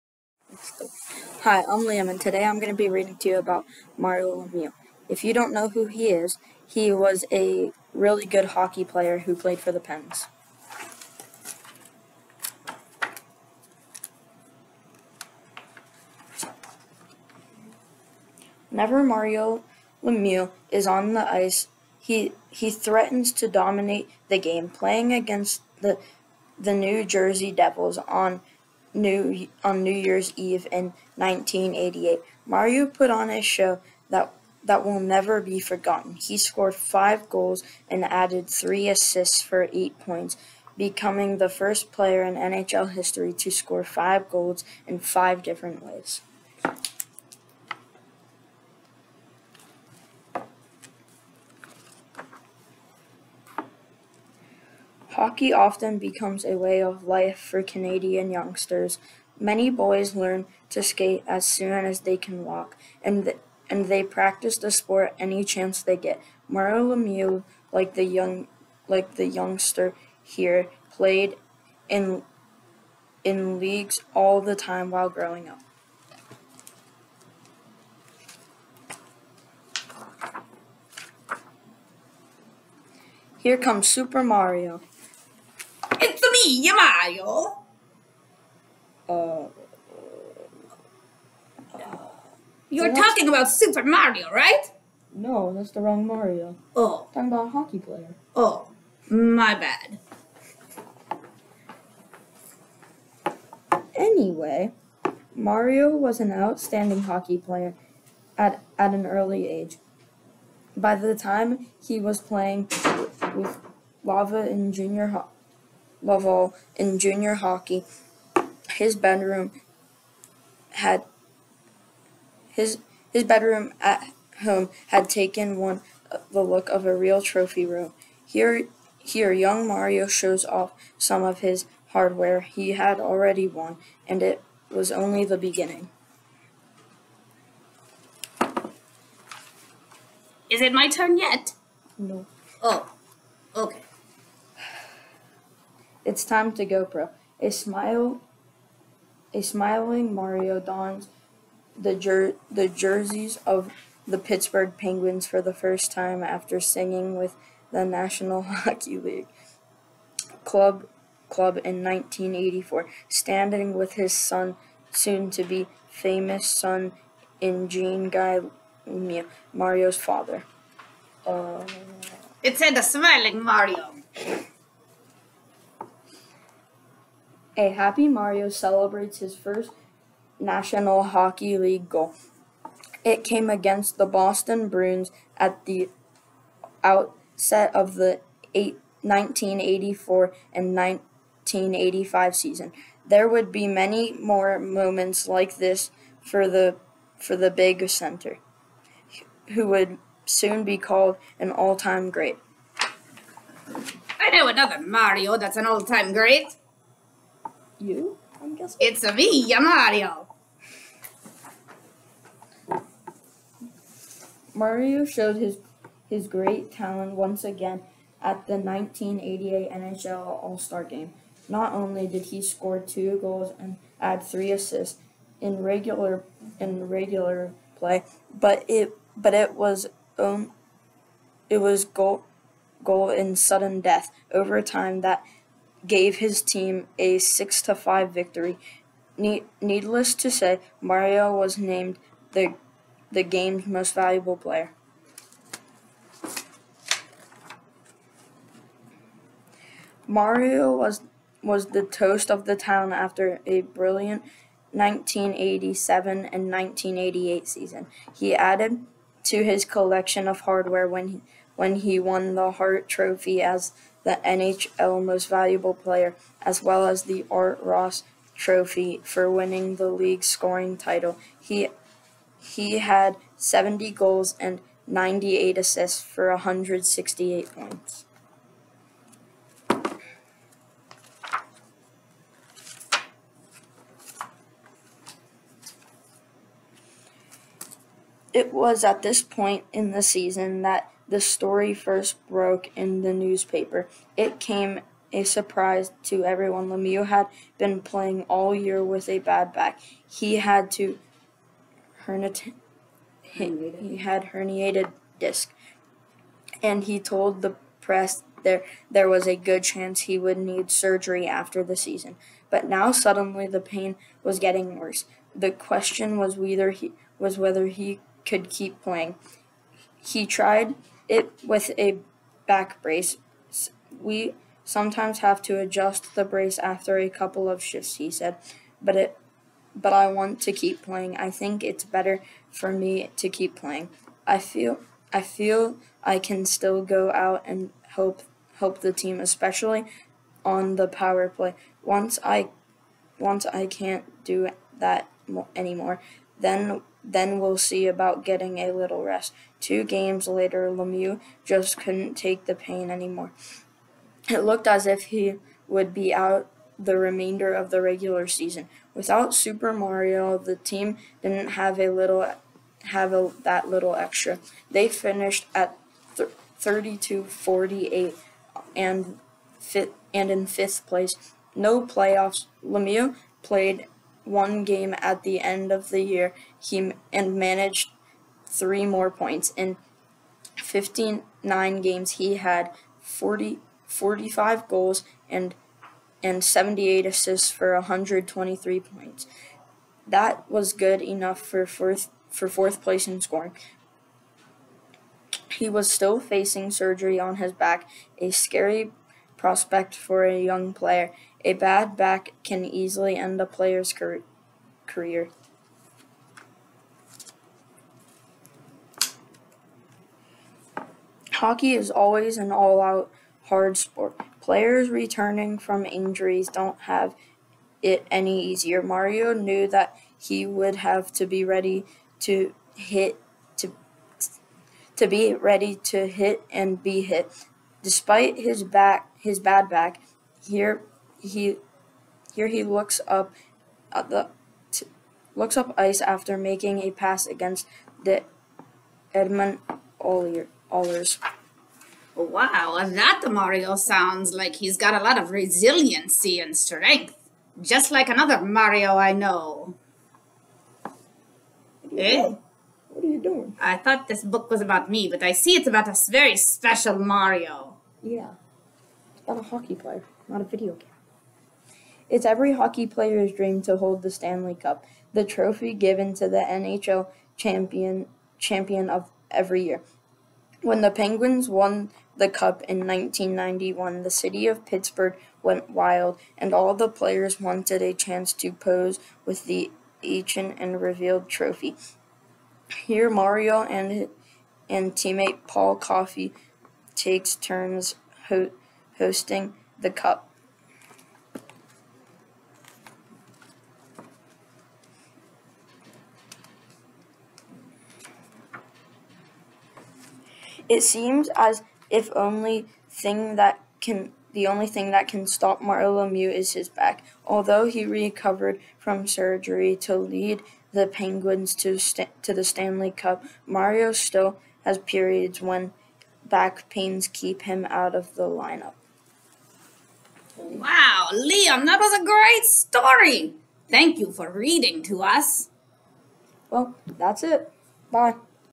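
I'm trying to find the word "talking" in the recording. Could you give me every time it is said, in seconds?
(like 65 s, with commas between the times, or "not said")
92 s, 97 s.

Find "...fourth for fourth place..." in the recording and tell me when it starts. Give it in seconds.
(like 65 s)
391 s.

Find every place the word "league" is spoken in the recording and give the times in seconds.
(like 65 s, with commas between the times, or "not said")
73 s, 158 s, 181 s, 269 s.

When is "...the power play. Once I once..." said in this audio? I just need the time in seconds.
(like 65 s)
340 s.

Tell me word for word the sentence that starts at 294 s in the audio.
It came a surprise to everyone.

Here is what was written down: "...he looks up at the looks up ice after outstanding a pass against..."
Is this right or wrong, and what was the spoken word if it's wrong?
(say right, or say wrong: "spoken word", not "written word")
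wrong: "making", not "outstanding".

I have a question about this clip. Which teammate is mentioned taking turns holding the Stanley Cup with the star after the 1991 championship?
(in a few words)
Paul Coffey.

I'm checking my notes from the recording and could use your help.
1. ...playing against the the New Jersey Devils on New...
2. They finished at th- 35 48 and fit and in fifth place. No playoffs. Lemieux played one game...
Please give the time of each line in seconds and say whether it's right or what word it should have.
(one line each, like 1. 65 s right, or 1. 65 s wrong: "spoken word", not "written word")
1. 24 s right
2. 364 s wrong: "32", not "35".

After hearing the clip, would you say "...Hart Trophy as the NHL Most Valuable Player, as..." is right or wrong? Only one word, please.
right.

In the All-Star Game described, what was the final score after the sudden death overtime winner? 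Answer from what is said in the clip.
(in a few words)
6 to 5.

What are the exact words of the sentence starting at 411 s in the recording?
Hockey is always an all out hard sport.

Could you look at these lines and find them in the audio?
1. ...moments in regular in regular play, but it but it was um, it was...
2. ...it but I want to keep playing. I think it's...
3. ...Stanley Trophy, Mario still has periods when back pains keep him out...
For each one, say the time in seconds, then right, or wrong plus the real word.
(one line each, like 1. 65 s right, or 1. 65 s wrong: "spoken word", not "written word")
1. 224 s wrong: "assists", not "moments"
2. 328 s right
3. 512 s wrong: "Cup", not "Trophy".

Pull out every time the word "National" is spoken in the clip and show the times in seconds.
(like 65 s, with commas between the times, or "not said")
157 s, 180 s.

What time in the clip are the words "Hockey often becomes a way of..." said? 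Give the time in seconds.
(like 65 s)
55 s.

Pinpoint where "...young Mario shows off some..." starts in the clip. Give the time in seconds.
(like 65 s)
129 s.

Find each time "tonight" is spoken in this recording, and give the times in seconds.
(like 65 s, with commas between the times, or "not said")
not said.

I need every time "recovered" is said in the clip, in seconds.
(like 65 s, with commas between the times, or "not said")
507 s.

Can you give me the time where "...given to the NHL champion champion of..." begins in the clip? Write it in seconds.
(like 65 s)
465 s.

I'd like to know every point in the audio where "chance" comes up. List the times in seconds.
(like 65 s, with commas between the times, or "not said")
65 s, 309 s, 477 s.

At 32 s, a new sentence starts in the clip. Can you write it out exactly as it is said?
Mario put on a show that that will never be forgotten.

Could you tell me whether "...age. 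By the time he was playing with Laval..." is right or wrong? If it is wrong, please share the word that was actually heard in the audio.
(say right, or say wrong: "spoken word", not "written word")
right.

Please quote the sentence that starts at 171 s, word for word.
Uh, it's in the smiling Mario.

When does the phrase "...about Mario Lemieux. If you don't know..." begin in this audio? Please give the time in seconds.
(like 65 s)
3 s.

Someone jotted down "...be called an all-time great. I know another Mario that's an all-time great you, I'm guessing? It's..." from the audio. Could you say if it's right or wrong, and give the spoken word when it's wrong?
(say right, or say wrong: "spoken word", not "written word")
right.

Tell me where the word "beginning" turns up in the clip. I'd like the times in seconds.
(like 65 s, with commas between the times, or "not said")
135 s.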